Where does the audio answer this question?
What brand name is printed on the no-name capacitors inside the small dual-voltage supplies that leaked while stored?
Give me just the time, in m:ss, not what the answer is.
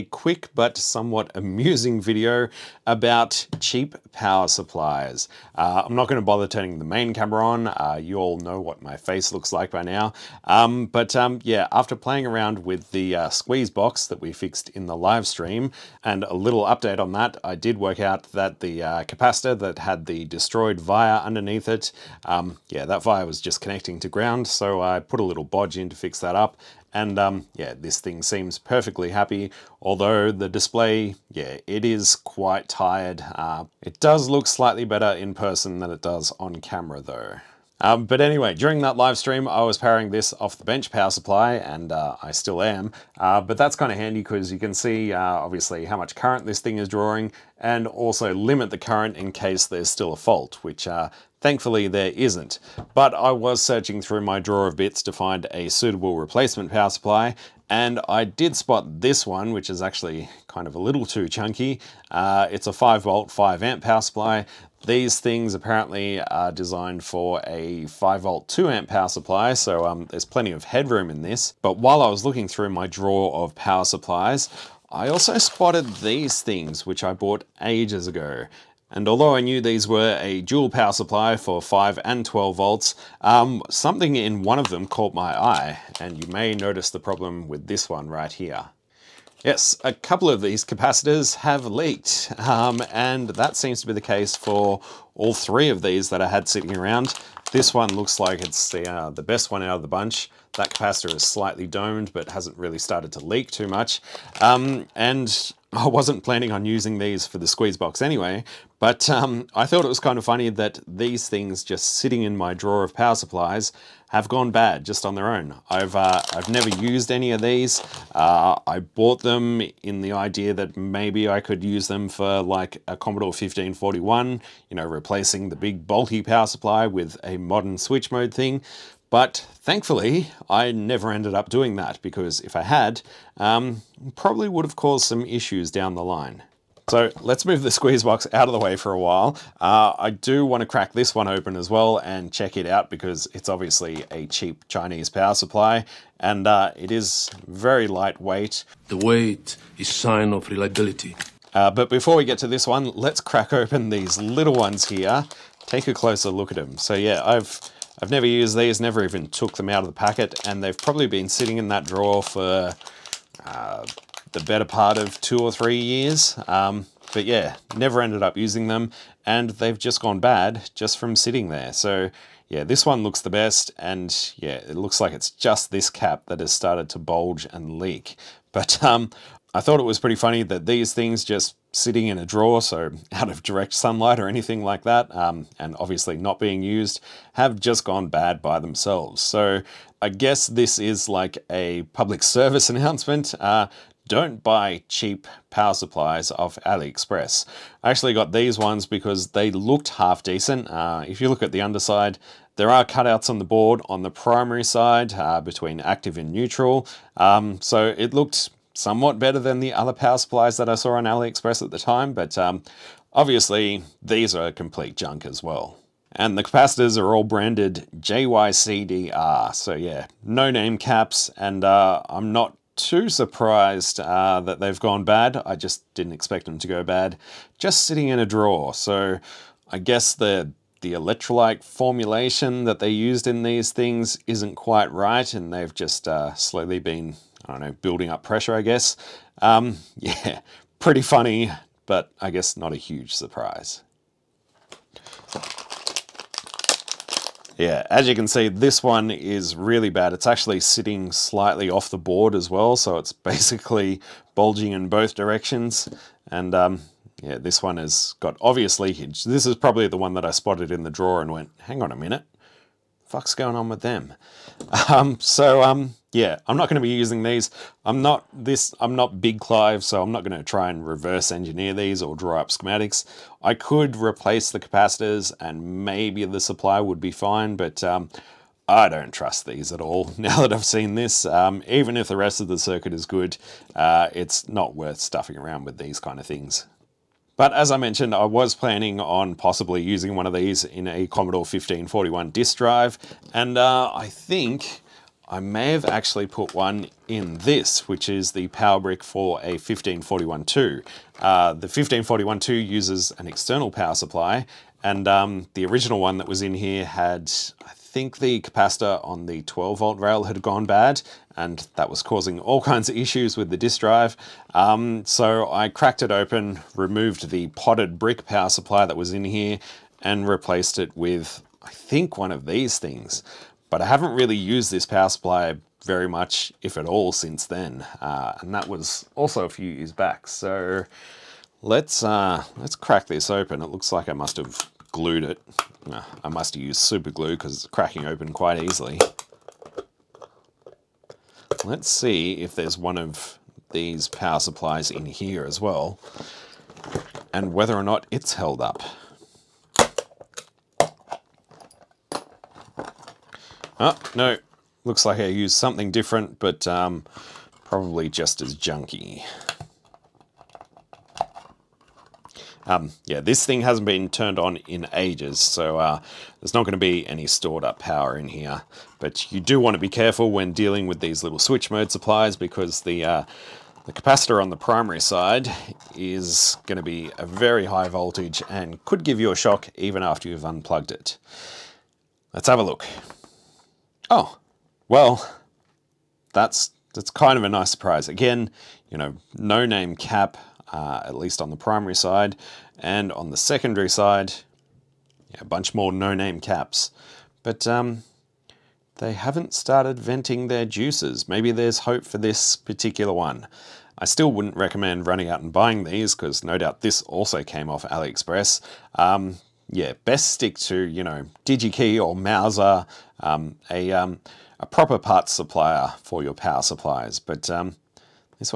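3:37.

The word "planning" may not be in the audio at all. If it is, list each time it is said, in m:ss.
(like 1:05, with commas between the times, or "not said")
1:46, 4:48.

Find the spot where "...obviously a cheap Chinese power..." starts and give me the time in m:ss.
2:23.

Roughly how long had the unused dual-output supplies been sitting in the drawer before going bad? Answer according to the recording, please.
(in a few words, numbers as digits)
2 or 3 years.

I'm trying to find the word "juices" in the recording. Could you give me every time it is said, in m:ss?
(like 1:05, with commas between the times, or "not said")
6:40.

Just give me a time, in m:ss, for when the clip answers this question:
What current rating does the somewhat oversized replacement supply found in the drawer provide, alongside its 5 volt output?
1:03.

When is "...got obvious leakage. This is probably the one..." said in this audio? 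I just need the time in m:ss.
4:18.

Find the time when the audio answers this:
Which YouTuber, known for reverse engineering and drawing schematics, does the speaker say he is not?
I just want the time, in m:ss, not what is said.
4:29.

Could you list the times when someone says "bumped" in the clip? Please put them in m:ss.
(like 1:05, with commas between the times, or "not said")
not said.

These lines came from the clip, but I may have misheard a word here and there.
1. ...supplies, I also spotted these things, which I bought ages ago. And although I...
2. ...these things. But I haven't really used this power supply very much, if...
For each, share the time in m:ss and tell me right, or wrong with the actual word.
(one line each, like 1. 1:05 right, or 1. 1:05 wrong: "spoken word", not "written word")
1. 1:13 right
2. 5:22 right.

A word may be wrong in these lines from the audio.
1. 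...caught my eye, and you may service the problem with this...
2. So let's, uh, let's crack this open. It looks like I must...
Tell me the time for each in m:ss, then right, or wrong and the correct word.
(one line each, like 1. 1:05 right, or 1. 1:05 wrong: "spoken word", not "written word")
1. 1:24 wrong: "notice", not "service"
2. 5:30 right.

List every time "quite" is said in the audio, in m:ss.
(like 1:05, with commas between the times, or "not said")
0:32, 3:54, 5:38.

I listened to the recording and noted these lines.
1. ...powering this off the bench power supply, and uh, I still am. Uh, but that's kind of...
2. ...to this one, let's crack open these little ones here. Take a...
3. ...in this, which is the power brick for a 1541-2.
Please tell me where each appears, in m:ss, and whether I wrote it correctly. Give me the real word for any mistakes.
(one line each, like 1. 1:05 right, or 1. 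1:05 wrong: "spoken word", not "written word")
1. 0:39 right
2. 2:32 right
3. 4:57 right.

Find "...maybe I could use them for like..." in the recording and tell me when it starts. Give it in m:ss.
2:00.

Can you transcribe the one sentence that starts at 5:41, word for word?
Let's see if there's one of these power supplies in here as well and whether or not it's held up.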